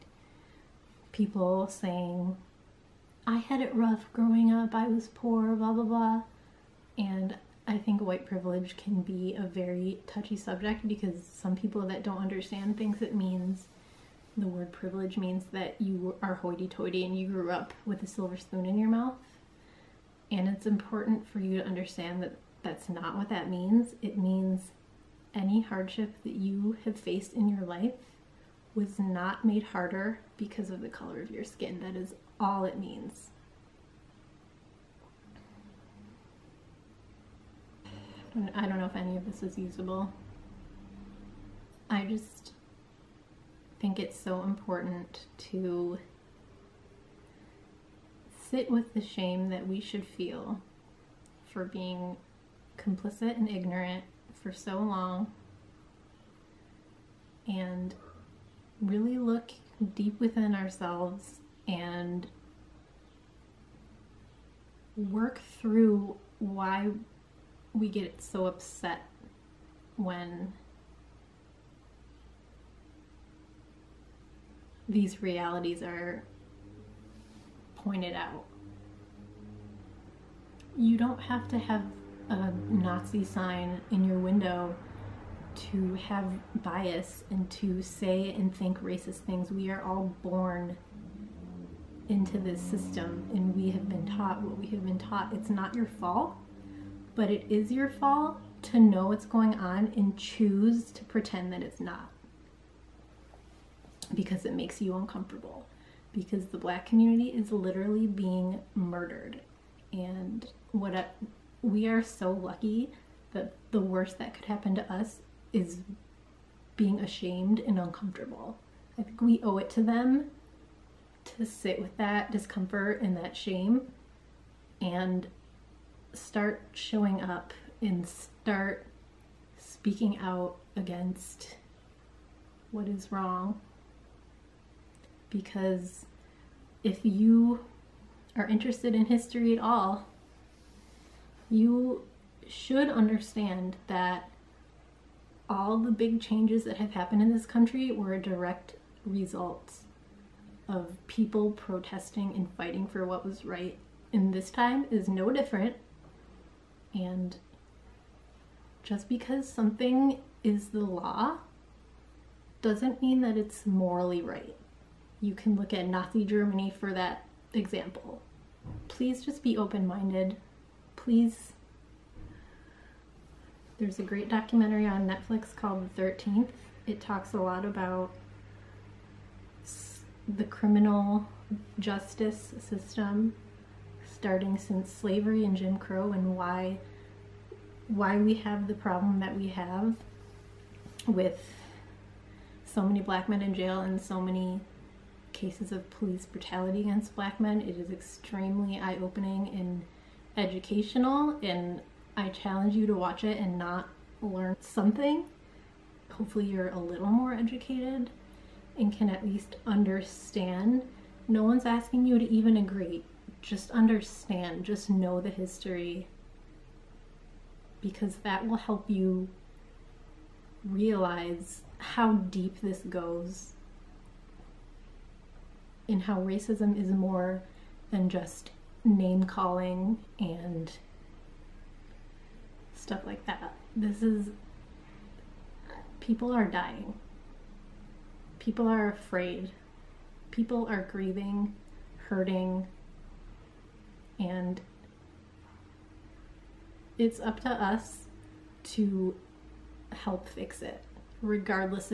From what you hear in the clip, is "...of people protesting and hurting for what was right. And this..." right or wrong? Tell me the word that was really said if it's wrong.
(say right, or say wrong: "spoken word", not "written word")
wrong: "fighting", not "hurting".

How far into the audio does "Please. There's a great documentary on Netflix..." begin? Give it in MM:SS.
02:50.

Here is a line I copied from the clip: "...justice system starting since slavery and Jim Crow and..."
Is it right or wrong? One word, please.
right.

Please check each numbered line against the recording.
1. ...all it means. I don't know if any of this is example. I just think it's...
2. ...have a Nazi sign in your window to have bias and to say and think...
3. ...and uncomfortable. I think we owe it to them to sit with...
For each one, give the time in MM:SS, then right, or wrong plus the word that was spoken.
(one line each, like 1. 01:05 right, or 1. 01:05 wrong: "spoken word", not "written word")
1. 00:32 wrong: "usable", not "example"
2. 01:21 right
3. 01:57 right.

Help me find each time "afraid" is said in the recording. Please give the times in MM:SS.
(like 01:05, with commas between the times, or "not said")
03:58.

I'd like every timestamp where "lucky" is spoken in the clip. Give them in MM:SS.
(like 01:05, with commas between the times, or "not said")
01:52.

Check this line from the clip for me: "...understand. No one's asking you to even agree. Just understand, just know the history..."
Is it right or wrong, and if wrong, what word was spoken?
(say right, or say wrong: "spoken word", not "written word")
right.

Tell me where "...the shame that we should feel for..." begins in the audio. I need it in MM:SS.
00:48.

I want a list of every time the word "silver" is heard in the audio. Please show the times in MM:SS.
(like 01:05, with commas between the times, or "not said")
00:18.